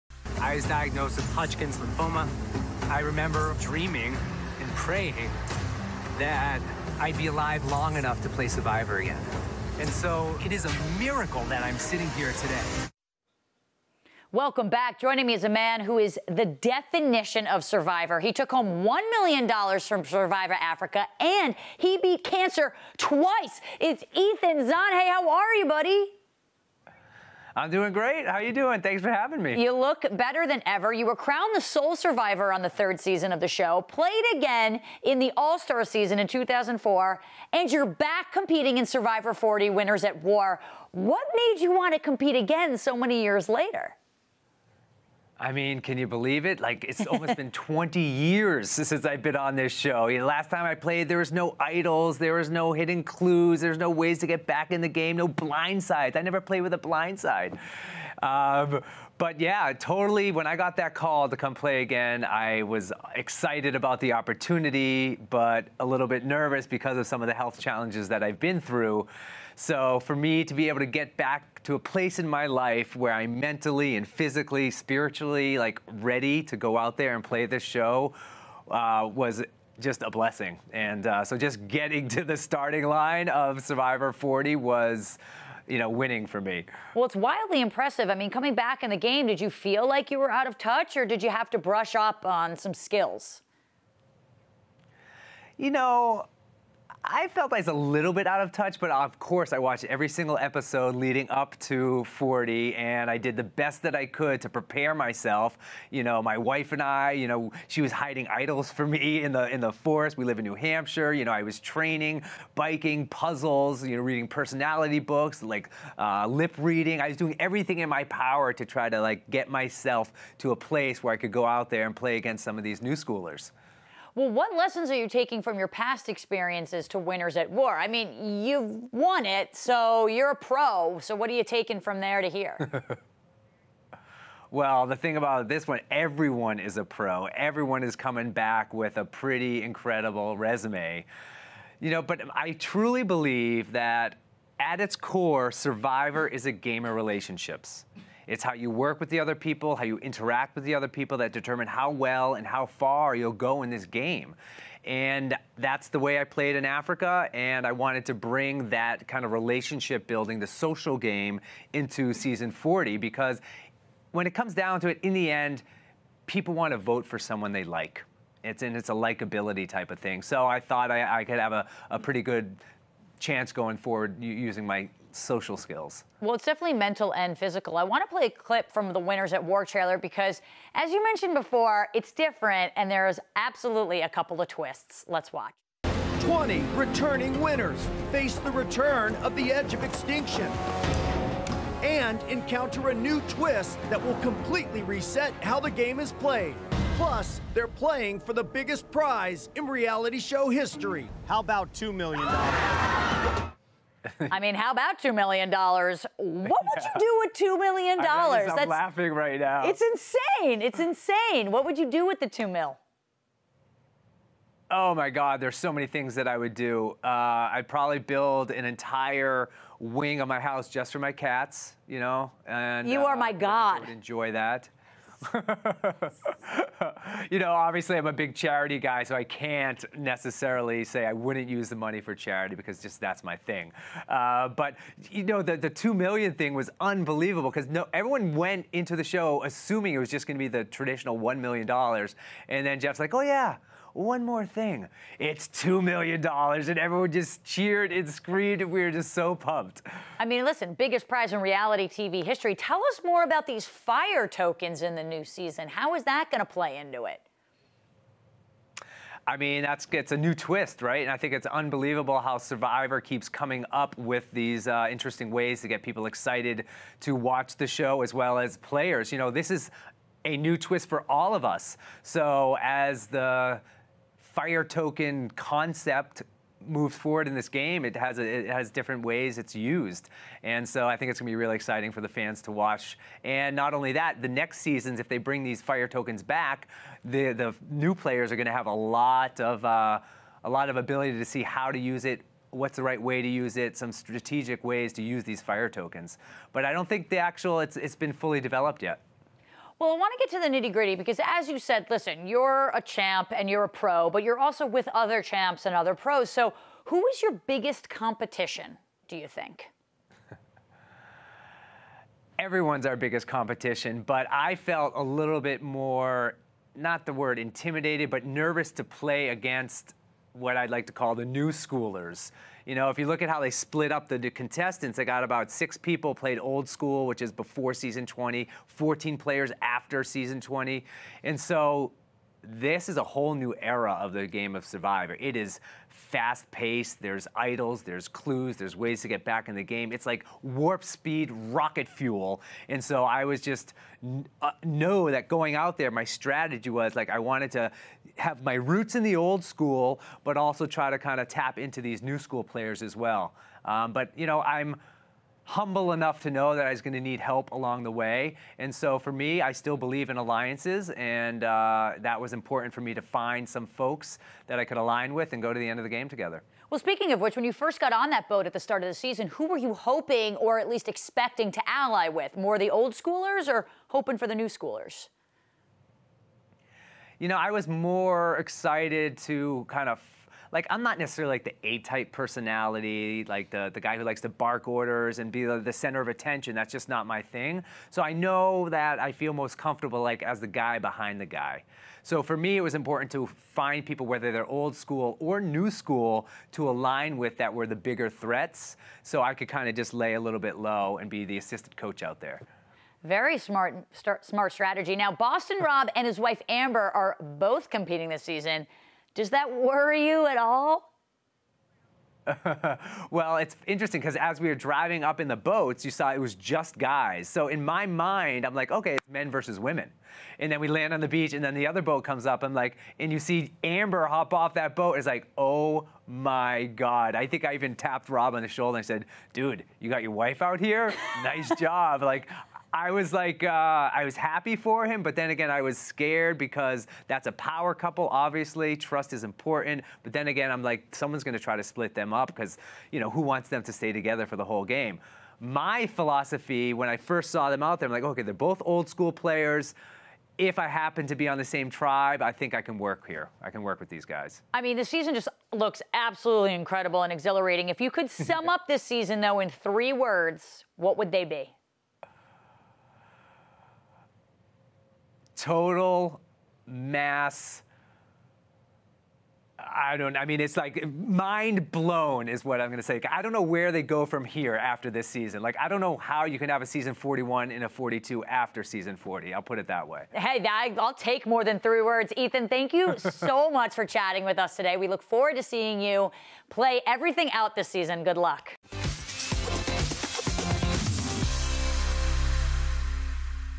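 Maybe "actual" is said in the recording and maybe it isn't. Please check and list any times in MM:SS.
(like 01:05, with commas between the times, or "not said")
04:57.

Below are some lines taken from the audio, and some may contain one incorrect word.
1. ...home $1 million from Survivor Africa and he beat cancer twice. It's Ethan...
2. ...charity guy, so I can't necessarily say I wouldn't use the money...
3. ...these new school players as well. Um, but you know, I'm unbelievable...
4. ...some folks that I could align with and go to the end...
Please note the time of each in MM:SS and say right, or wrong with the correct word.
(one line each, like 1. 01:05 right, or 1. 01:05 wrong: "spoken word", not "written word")
1. 00:18 right
2. 03:48 right
3. 05:51 wrong: "humble", not "unbelievable"
4. 06:03 right.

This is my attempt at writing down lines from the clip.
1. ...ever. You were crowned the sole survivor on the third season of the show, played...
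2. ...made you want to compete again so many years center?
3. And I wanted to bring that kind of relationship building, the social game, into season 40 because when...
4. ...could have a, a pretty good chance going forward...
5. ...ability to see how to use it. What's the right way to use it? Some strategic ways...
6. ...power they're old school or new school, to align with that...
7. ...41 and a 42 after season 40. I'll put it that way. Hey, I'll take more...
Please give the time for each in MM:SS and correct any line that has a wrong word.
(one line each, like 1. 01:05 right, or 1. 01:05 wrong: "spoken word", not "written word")
1. 00:30 right
2. 00:41 wrong: "later", not "center"
3. 02:37 right
4. 02:51 right
5. 04:50 right
6. 06:34 wrong: "whether", not "power"
7. 07:56 right.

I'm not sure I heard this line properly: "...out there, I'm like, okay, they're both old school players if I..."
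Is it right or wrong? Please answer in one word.
right.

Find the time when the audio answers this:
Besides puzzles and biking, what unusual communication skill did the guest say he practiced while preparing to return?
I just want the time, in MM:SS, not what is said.
01:56.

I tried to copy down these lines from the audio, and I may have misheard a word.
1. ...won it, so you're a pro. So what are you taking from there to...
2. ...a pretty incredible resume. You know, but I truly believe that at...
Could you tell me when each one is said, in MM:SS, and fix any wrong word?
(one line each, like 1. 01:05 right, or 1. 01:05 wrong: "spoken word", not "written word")
1. 02:08 right
2. 02:18 right.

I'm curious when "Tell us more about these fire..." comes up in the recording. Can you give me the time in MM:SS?
04:12.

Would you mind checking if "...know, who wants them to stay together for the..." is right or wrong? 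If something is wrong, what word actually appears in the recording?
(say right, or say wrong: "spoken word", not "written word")
right.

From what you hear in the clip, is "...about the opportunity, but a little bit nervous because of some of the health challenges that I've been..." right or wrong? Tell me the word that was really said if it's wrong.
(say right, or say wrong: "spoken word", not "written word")
right.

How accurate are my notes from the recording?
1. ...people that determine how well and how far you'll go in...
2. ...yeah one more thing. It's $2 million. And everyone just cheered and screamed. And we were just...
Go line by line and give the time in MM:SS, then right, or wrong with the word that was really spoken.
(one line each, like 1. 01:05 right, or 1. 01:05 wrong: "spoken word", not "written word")
1. 02:30 right
2. 04:03 right.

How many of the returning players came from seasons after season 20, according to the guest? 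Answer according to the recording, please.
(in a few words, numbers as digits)
14.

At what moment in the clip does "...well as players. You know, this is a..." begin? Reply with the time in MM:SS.
04:28.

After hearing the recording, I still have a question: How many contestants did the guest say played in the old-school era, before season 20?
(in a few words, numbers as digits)
6.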